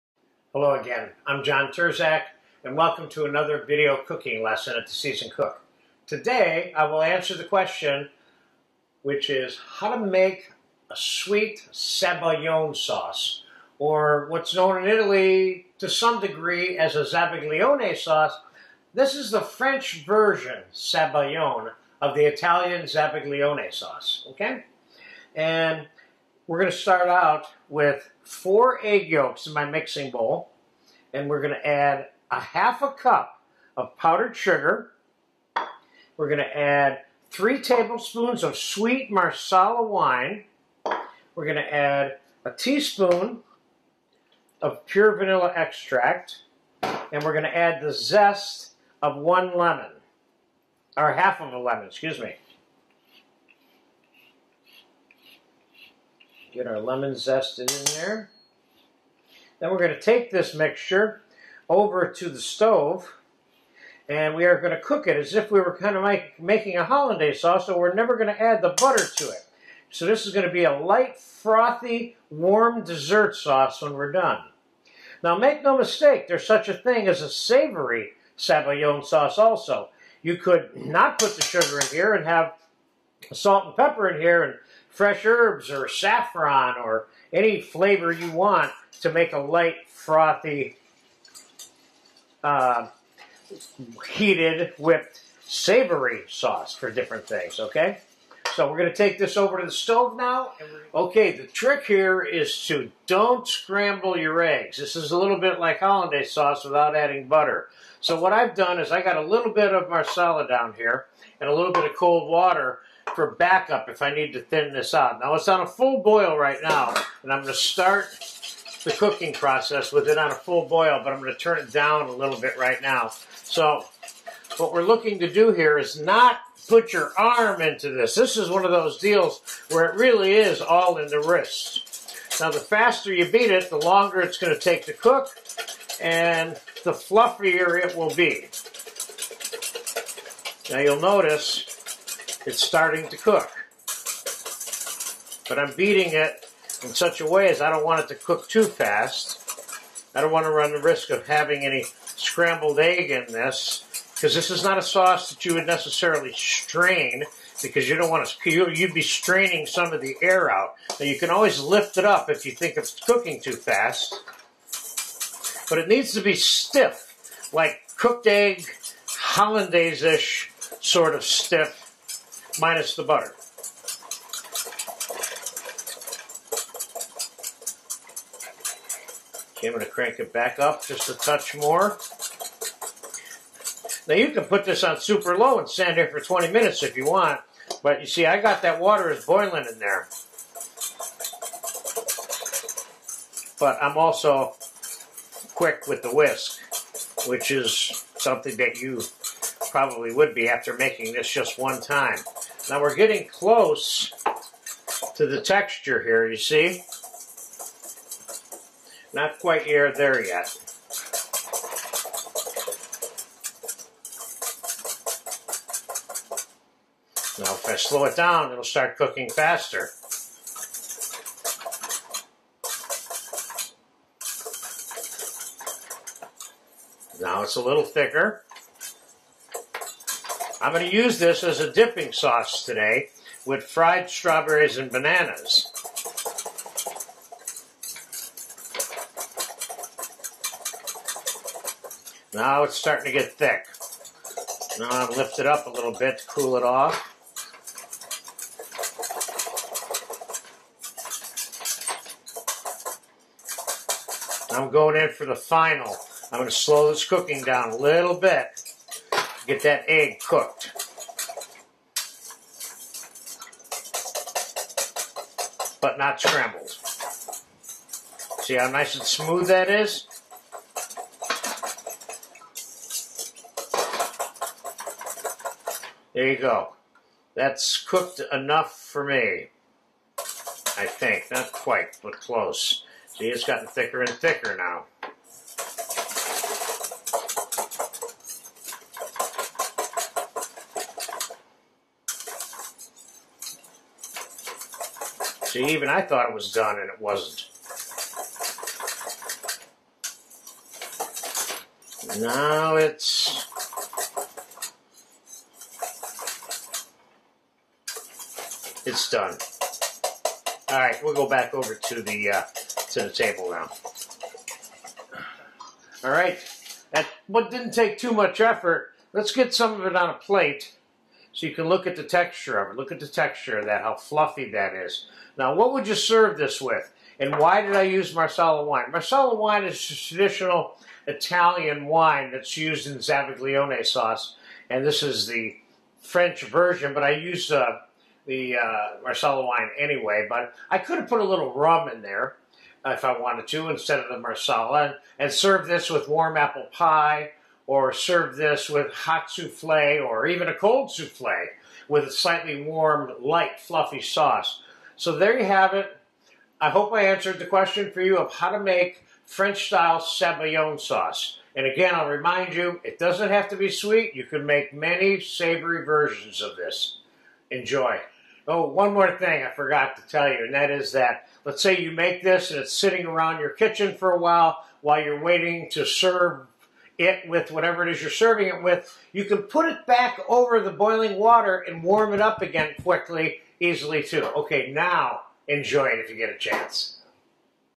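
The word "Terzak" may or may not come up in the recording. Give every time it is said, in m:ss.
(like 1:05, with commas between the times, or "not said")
0:01.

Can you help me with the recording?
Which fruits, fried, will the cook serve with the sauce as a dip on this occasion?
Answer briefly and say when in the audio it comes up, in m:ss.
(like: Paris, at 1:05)
strawberries and bananas, at 3:54.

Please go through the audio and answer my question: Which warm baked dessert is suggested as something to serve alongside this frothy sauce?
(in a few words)
apple pie.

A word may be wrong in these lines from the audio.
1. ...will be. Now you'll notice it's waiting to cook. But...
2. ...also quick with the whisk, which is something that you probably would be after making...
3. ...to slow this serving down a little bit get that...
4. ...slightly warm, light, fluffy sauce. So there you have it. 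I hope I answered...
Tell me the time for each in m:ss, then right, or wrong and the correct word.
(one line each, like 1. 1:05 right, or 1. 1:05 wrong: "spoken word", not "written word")
1. 2:17 wrong: "starting", not "waiting"
2. 3:13 right
3. 4:16 wrong: "cooking", not "serving"
4. 5:52 right.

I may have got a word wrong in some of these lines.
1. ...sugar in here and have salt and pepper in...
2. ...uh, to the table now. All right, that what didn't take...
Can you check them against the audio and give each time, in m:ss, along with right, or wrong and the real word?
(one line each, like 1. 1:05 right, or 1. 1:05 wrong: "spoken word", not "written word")
1. 1:21 right
2. 5:12 right.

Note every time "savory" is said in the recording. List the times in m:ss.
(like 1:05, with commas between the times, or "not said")
1:17, 1:35, 6:05.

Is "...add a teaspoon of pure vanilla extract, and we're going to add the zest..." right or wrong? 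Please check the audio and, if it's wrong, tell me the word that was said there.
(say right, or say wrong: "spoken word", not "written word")
right.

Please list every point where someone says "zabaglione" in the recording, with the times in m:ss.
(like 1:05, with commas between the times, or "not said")
0:17, 0:22, 5:32.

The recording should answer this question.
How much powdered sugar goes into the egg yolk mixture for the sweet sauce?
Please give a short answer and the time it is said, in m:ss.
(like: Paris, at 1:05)
half a cup, at 0:32.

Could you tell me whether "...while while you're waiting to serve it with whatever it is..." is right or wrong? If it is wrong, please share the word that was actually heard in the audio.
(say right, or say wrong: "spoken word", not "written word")
right.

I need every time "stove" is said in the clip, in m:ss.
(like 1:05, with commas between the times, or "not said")
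1:02, 1:39.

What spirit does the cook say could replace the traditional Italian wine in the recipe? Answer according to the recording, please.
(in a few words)
rum.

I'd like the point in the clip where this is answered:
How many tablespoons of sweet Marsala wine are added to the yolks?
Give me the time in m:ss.
0:37.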